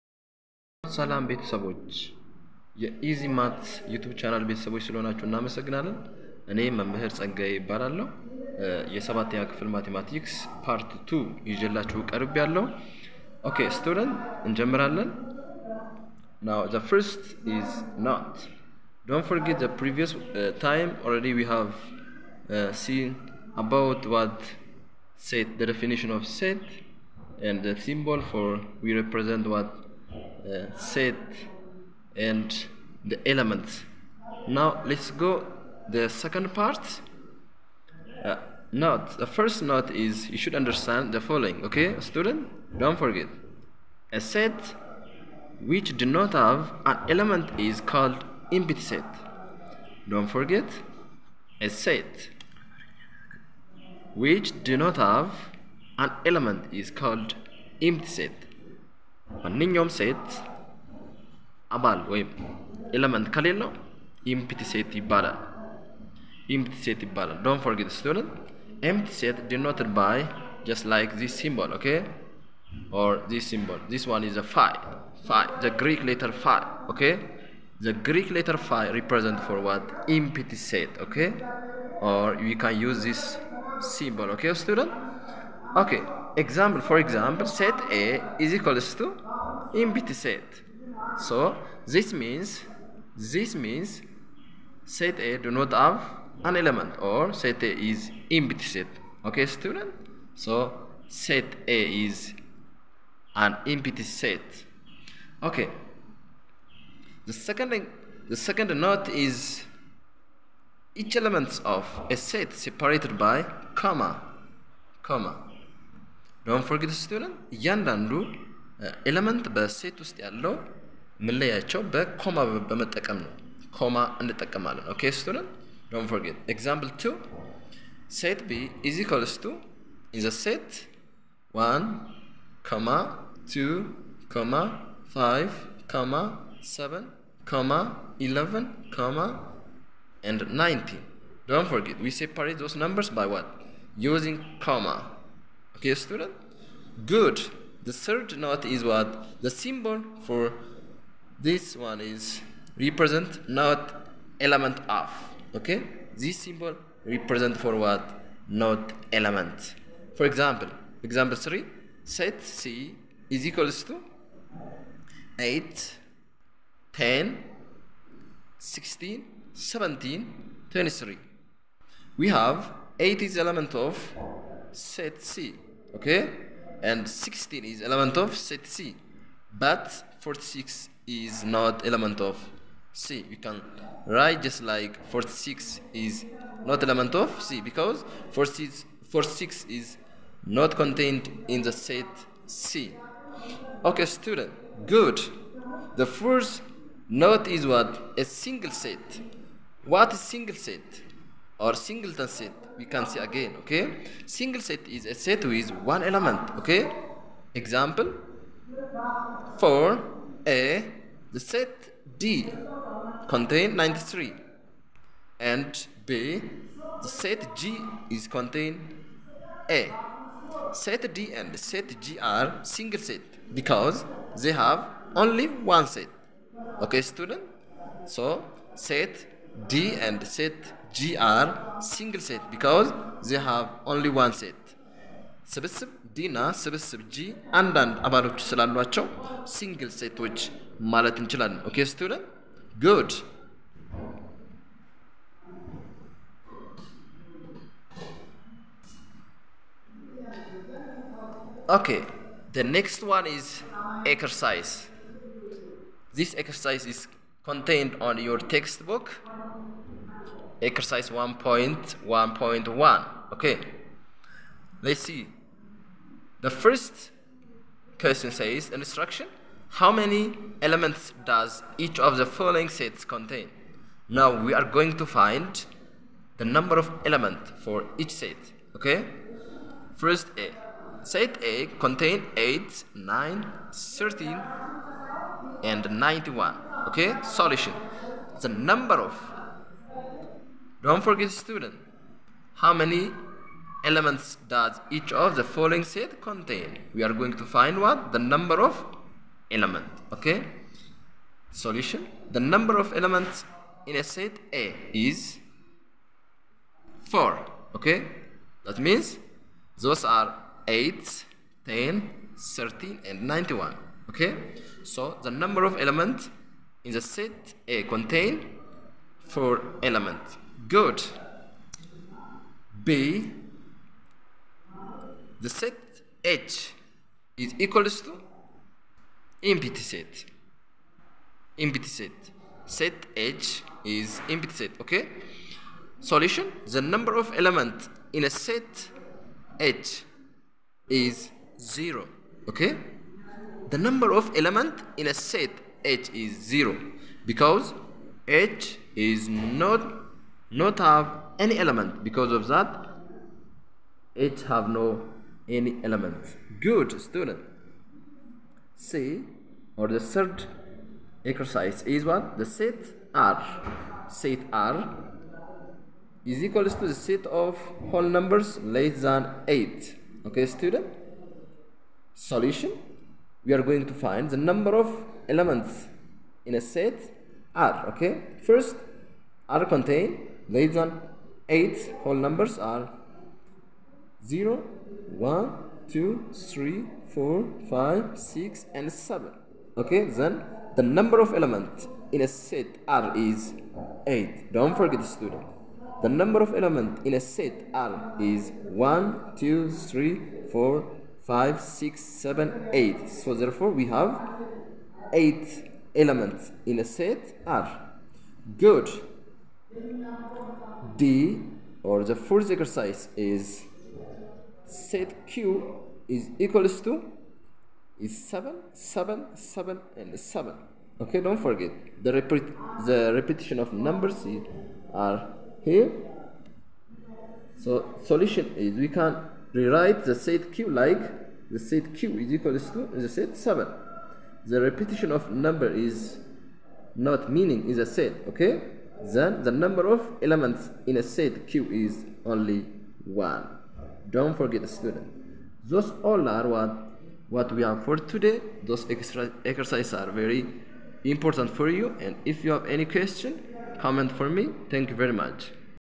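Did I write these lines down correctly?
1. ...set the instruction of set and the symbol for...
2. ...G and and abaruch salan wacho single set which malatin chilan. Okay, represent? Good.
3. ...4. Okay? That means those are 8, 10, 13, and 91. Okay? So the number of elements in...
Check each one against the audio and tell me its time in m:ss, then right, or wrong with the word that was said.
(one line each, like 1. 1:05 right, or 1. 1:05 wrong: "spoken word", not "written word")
1. 0:25 wrong: "definition", not "instruction"
2. 3:57 wrong: "student", not "represent"
3. 5:07 right.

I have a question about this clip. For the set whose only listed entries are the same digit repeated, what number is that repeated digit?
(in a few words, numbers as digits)
7.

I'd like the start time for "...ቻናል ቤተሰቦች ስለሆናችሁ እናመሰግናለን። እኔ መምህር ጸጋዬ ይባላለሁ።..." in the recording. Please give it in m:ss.
0:04.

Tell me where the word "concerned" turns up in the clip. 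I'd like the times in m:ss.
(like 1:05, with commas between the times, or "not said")
not said.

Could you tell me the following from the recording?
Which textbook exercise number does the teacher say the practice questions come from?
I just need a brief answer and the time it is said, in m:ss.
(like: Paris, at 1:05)
1.1.1, at 4:20.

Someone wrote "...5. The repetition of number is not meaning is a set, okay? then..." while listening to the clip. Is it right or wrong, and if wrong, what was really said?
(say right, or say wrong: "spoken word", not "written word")
wrong: "7", not "5".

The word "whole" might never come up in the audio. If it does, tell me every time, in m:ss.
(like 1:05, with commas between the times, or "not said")
6:07, 6:22.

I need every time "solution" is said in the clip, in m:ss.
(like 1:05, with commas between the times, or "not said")
4:47, 5:01, 5:35, 6:12, 7:08.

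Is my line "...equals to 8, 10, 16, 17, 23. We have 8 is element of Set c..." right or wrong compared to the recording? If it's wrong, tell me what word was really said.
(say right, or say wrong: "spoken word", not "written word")
right.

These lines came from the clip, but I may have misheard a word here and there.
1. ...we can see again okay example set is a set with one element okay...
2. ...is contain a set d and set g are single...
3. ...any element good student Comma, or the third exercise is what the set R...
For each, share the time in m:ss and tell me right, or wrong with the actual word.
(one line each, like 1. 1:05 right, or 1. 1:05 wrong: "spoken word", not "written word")
1. 3:22 wrong: "single", not "example"
2. 3:38 right
3. 5:55 wrong: "See", not "Comma".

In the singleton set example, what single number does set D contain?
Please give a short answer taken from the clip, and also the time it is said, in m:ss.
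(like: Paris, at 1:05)
93, at 3:33.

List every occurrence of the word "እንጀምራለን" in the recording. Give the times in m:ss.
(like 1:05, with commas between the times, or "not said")
0:14.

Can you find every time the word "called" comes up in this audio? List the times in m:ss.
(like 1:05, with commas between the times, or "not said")
0:47, 0:56.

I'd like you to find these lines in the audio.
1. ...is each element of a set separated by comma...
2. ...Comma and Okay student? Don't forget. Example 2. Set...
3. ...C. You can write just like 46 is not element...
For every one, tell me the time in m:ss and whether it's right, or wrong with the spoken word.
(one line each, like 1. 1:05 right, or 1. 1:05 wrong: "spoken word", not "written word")
1. 1:49 right
2. 2:03 right
3. 3:02 right.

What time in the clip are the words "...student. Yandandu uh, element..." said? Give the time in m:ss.
1:57.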